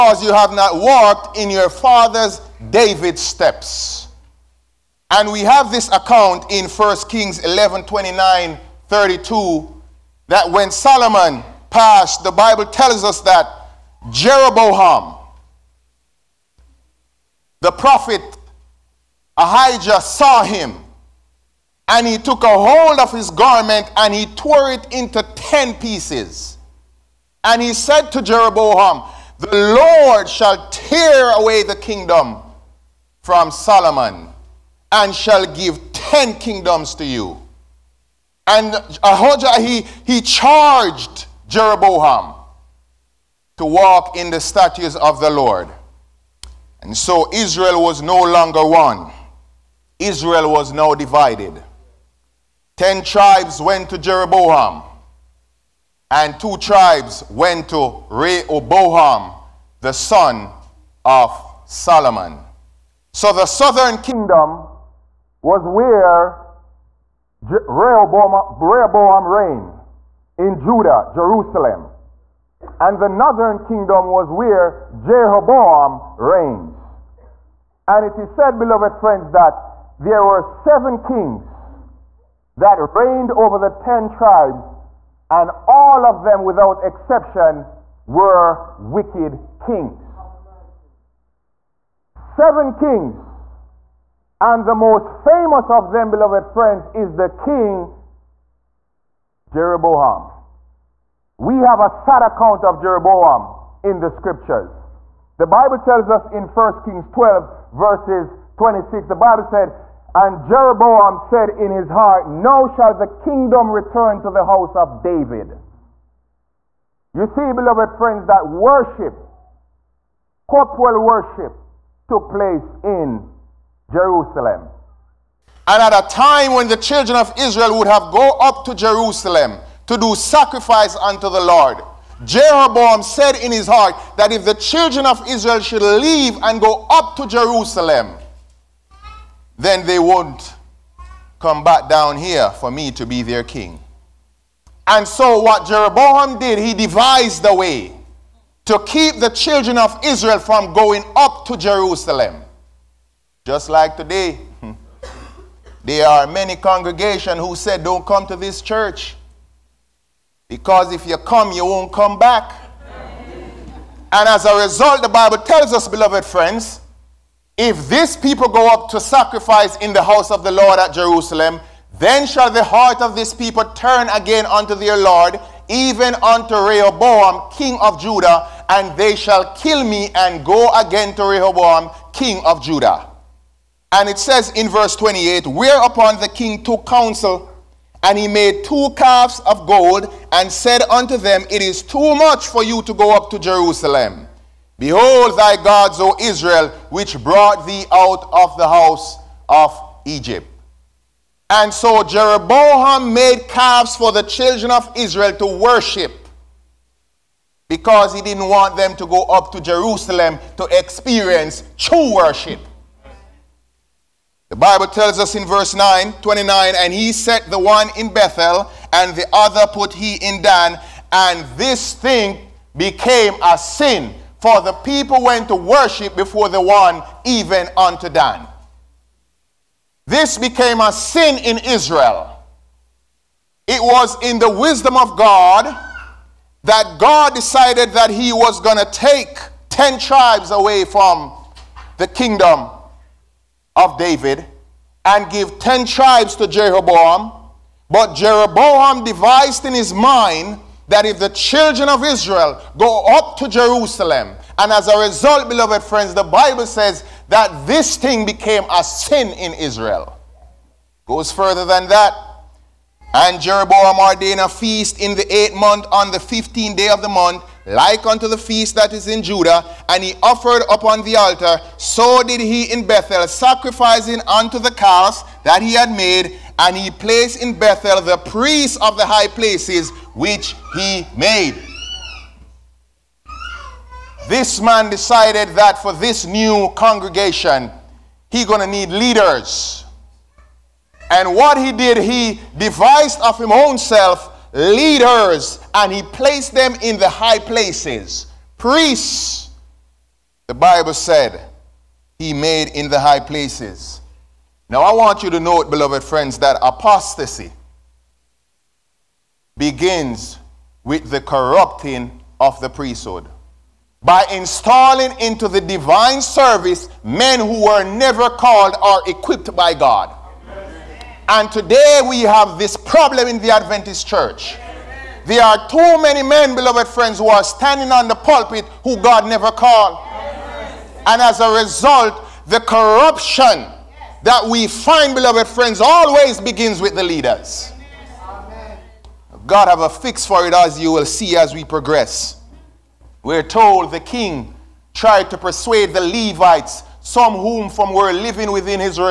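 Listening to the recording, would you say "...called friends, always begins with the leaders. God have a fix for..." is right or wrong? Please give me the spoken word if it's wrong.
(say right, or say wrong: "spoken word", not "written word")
wrong: "beloved", not "called".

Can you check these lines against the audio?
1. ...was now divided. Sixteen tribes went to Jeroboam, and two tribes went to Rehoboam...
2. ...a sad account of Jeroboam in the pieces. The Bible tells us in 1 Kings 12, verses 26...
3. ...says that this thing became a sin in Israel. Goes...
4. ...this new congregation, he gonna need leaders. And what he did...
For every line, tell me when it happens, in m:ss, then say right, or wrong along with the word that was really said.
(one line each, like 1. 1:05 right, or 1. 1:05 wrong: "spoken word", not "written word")
1. 0:50 wrong: "Ten", not "Sixteen"
2. 1:41 wrong: "scriptures", not "pieces"
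3. 4:16 right
4. 4:45 right.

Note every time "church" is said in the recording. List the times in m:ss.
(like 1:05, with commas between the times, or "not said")
2:38, 5:24.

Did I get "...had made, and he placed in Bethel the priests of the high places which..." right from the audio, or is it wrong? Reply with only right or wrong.
right.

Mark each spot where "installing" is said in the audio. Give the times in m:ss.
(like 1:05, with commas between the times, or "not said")
5:14.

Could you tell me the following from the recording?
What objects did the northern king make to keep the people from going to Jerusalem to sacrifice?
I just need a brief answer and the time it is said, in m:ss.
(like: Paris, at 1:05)
two calves of gold, at 3:08.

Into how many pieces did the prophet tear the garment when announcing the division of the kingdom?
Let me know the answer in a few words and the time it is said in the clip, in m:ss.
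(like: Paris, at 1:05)
10, at 0:25.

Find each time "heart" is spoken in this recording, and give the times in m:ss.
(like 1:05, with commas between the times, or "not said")
1:51, 2:13, 2:52.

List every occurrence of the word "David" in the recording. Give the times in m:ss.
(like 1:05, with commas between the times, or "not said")
0:02, 1:55, 4:03.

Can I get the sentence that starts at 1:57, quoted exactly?
You see, beloved friends, that worship, corporal worship, took place in Jerusalem.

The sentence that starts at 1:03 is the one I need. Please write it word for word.
So the southern kingdom was where Je- Rehoboam, Rehoboam reigned in Judah, Jerusalem.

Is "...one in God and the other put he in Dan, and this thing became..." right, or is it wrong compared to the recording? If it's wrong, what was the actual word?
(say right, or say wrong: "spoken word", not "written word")
wrong: "Bethel", not "God".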